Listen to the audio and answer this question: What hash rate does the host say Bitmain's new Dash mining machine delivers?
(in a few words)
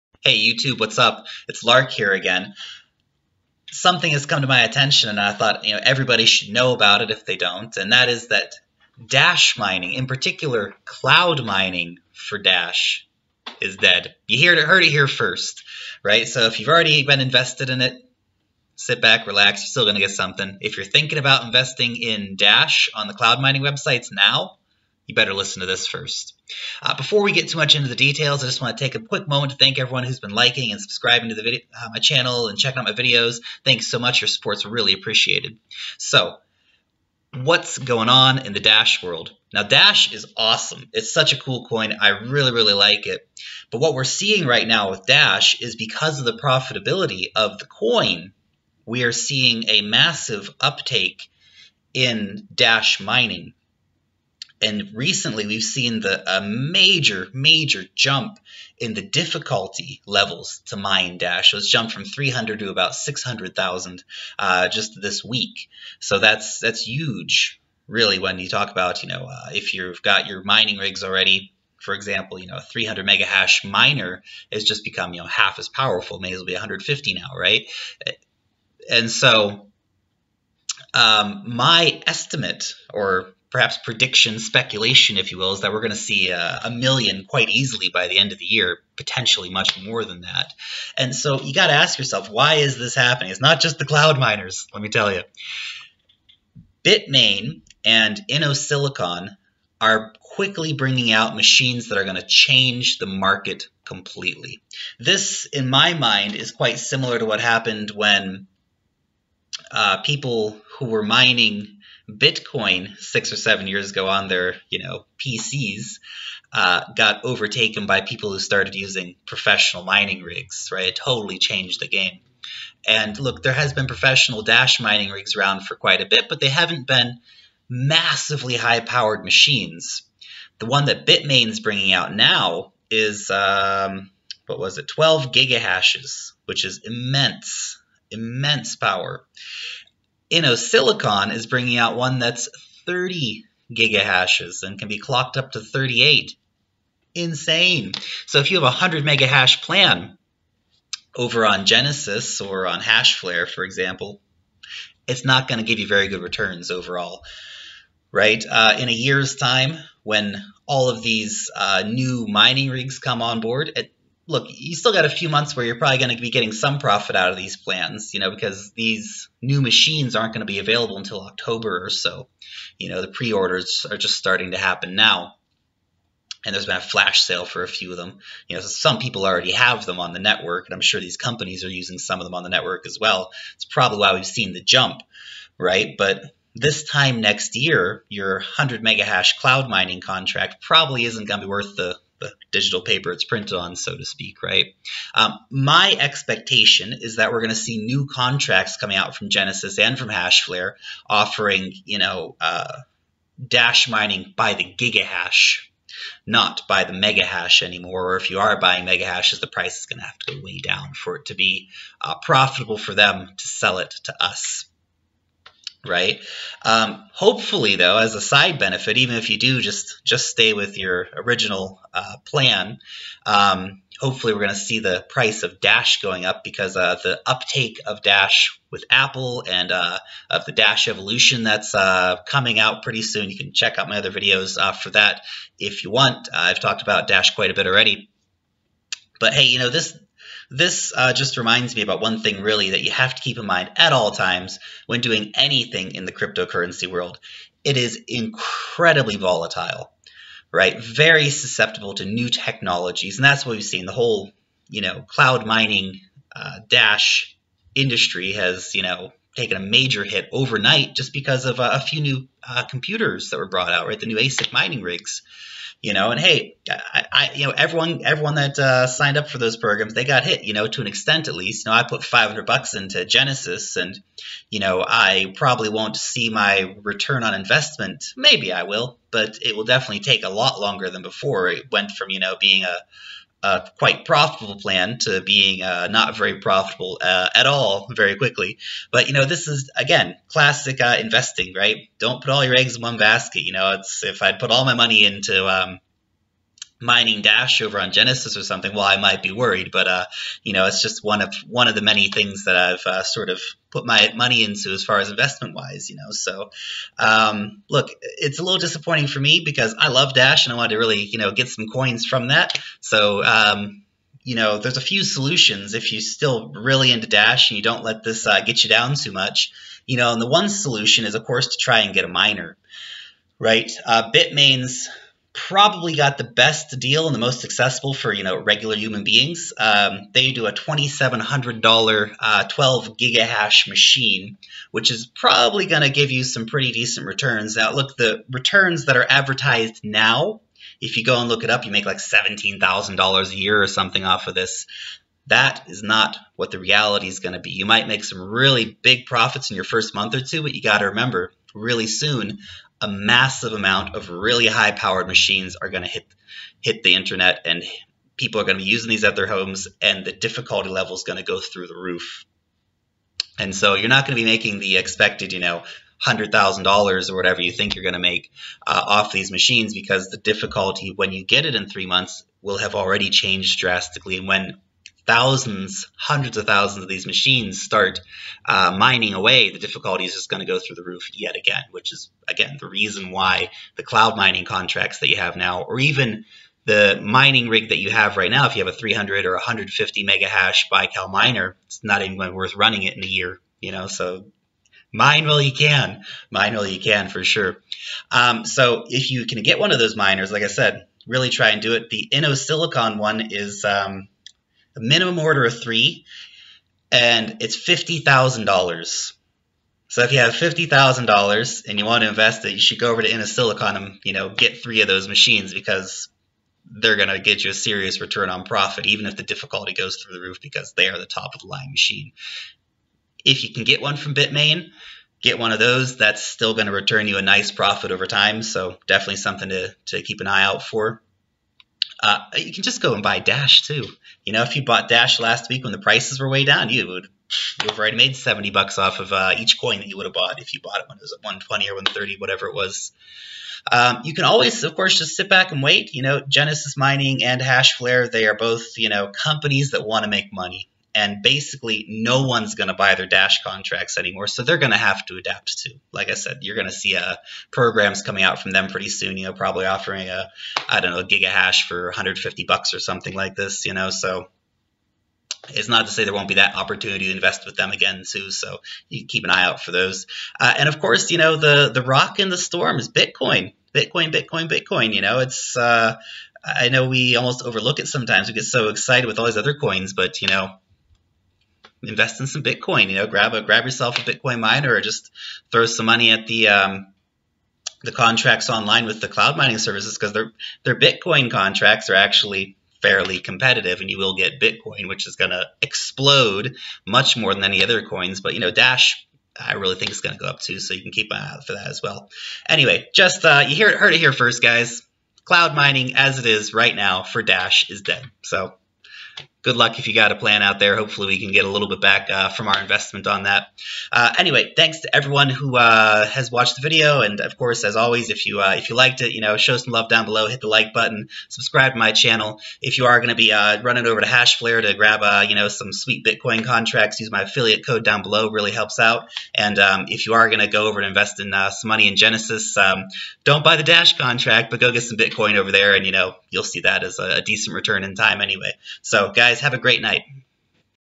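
12 gigahashes.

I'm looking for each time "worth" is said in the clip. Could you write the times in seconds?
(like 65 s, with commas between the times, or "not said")
191 s, 392 s.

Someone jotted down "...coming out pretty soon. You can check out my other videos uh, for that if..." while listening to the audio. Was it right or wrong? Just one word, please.
right.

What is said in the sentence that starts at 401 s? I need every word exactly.
The InnoSilicon one is um, a minimum order of three, and it's fifty thousand dollars.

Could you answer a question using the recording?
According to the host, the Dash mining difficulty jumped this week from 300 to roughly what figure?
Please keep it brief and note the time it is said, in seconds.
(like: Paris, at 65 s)
600000, at 62 s.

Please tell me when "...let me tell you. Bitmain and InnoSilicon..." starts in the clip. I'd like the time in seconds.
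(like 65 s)
94 s.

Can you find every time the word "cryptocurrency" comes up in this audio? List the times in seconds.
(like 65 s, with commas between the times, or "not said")
246 s.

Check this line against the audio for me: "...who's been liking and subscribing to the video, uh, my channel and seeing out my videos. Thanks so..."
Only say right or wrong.
wrong.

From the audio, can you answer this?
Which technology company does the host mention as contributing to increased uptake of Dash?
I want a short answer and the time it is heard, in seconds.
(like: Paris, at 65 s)
Apple, at 228 s.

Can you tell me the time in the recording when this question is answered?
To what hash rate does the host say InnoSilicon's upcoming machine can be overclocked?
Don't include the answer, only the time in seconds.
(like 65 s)
145 s.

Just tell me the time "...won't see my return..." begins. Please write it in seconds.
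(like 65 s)
275 s.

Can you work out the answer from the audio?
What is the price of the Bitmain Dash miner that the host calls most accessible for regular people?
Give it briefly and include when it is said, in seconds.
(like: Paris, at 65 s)
$2,700, at 330 s.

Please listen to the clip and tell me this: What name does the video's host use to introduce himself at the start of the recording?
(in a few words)
Lark.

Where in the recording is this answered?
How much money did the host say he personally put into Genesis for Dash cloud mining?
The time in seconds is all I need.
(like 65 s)
272 s.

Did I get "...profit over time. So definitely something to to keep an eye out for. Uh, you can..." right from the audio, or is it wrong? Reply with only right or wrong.
right.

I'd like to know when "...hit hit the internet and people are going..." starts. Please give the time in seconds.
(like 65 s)
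355 s.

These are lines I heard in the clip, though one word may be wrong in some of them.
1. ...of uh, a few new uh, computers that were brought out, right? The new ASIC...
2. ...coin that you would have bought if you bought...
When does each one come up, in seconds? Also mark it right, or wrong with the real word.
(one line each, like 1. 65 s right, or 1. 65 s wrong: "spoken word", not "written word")
1. 261 s right
2. 439 s right.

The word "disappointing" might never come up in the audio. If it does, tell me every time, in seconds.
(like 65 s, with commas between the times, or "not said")
308 s.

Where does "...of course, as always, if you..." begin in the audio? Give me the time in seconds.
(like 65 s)
517 s.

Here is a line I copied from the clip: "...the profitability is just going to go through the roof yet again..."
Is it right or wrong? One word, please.
wrong.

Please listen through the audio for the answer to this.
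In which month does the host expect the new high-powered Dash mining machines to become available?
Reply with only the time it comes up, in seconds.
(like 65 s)
171 s.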